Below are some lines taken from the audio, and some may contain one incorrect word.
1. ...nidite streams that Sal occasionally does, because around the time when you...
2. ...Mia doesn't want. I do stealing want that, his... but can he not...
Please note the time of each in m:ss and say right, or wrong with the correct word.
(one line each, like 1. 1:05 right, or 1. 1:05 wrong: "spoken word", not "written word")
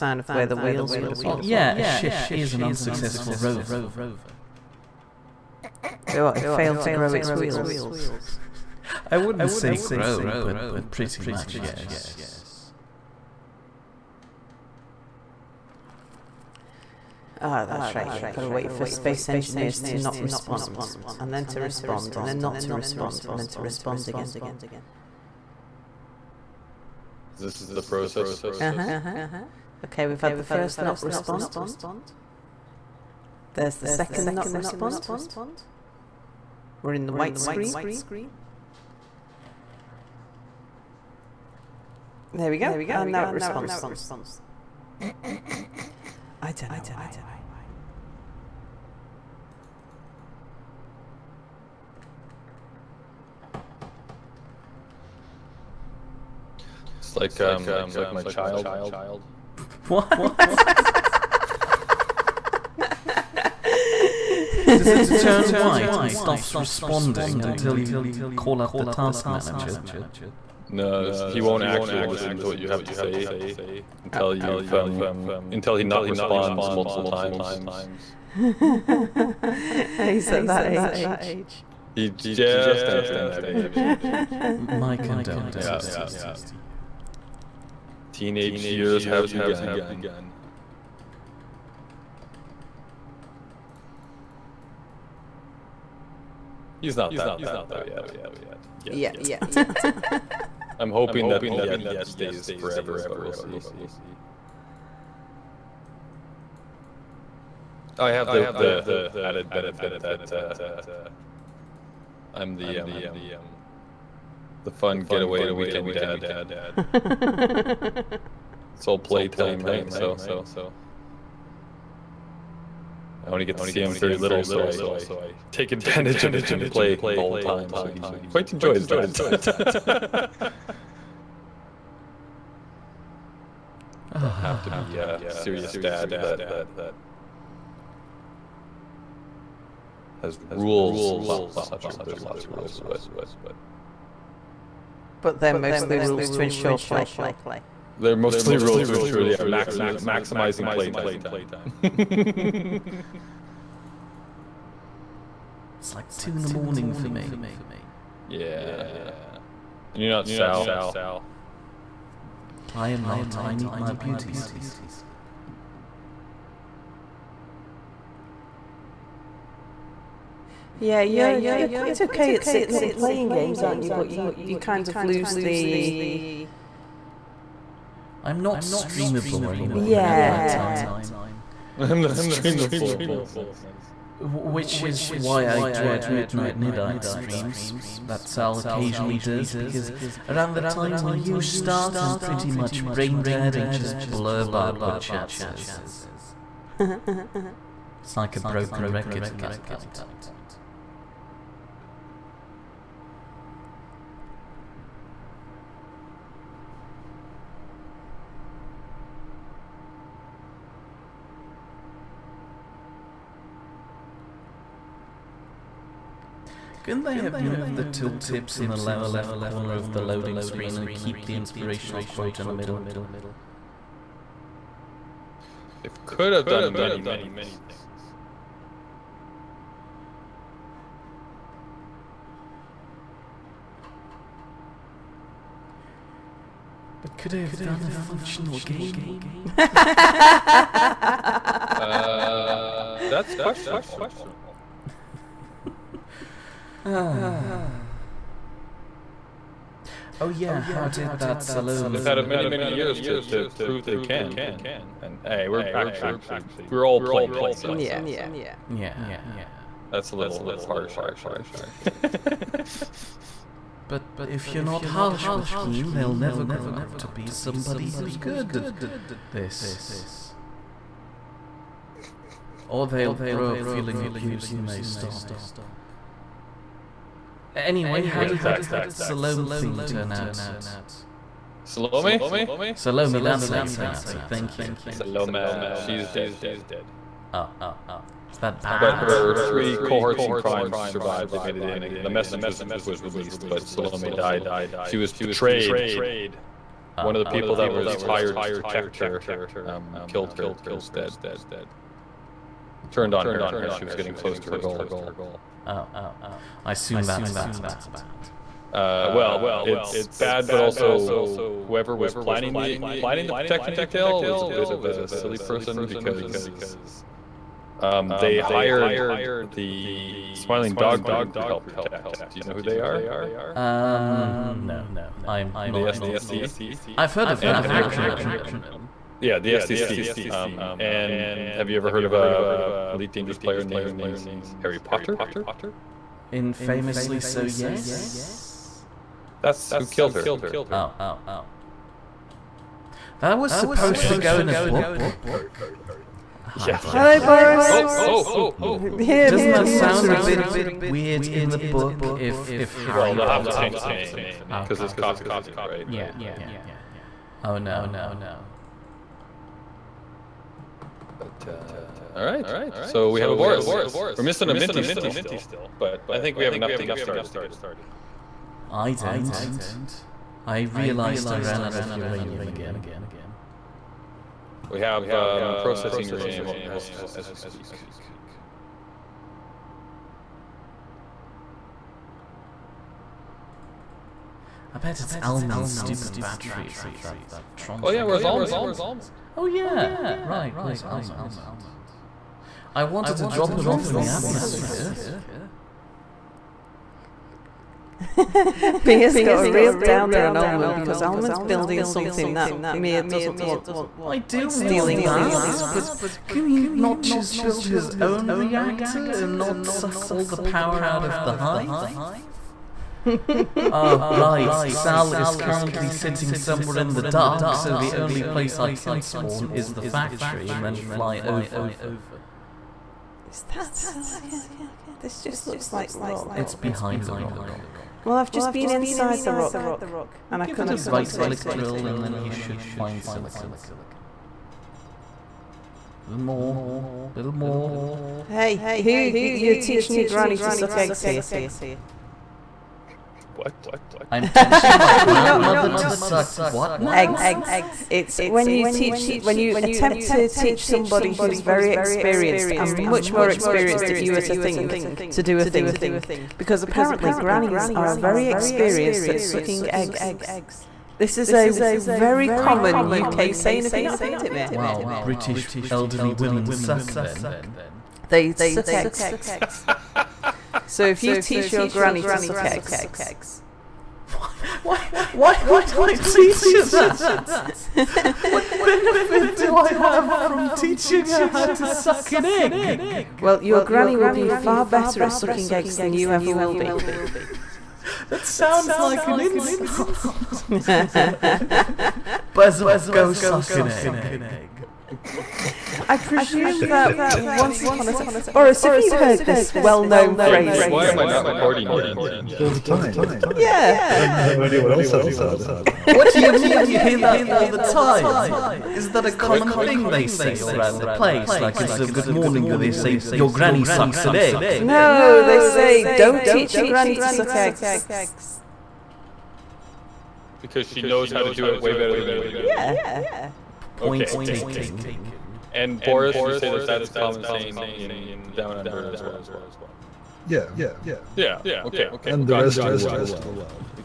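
1. 3:06 right
2. 6:42 right.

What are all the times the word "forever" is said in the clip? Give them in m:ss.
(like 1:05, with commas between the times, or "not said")
1:42.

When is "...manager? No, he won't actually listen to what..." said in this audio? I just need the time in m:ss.
1:09.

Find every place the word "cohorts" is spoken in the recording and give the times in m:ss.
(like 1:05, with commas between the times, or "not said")
4:49.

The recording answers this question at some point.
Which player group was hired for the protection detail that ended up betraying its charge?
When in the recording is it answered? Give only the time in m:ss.
5:20.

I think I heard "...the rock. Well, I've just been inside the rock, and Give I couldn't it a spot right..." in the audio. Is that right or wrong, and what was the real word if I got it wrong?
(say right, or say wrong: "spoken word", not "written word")
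right.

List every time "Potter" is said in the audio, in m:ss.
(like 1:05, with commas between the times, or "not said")
5:34, 5:53.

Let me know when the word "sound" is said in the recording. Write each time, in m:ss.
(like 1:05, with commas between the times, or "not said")
5:49, 8:08.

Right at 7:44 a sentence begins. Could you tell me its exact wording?
Wow, British elderly women suck then.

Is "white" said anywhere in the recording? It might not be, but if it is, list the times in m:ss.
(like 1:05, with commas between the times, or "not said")
0:37, 1:05.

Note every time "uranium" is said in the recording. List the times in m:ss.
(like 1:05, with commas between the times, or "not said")
6:11, 6:16.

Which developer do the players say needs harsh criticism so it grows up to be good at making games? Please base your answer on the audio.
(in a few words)
Keen.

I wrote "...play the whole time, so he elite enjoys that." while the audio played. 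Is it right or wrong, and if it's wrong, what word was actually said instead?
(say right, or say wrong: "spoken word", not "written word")
wrong: "quite", not "elite".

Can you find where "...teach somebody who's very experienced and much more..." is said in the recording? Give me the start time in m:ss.
7:30.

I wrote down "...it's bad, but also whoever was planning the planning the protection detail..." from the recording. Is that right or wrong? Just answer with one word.
right.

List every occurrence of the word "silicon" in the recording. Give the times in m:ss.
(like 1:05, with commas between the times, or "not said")
7:03, 7:13.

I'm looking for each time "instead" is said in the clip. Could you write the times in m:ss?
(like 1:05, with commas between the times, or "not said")
5:00, 8:31.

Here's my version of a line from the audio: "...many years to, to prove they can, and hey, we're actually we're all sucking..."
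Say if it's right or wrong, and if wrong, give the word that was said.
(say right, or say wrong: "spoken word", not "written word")
wrong: "playing", not "sucking".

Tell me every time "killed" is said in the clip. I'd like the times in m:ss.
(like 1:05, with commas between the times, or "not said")
5:00, 5:39.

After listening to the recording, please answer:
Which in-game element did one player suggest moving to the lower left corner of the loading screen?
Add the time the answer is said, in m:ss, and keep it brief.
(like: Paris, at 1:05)
tooltips, at 3:37.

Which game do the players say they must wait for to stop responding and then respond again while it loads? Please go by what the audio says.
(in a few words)
Space Engineers.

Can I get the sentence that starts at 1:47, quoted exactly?
I have the the added benefit that uh, I'm the um, the fun getaway weekend dad.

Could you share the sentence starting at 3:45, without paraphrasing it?
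They could have done many things.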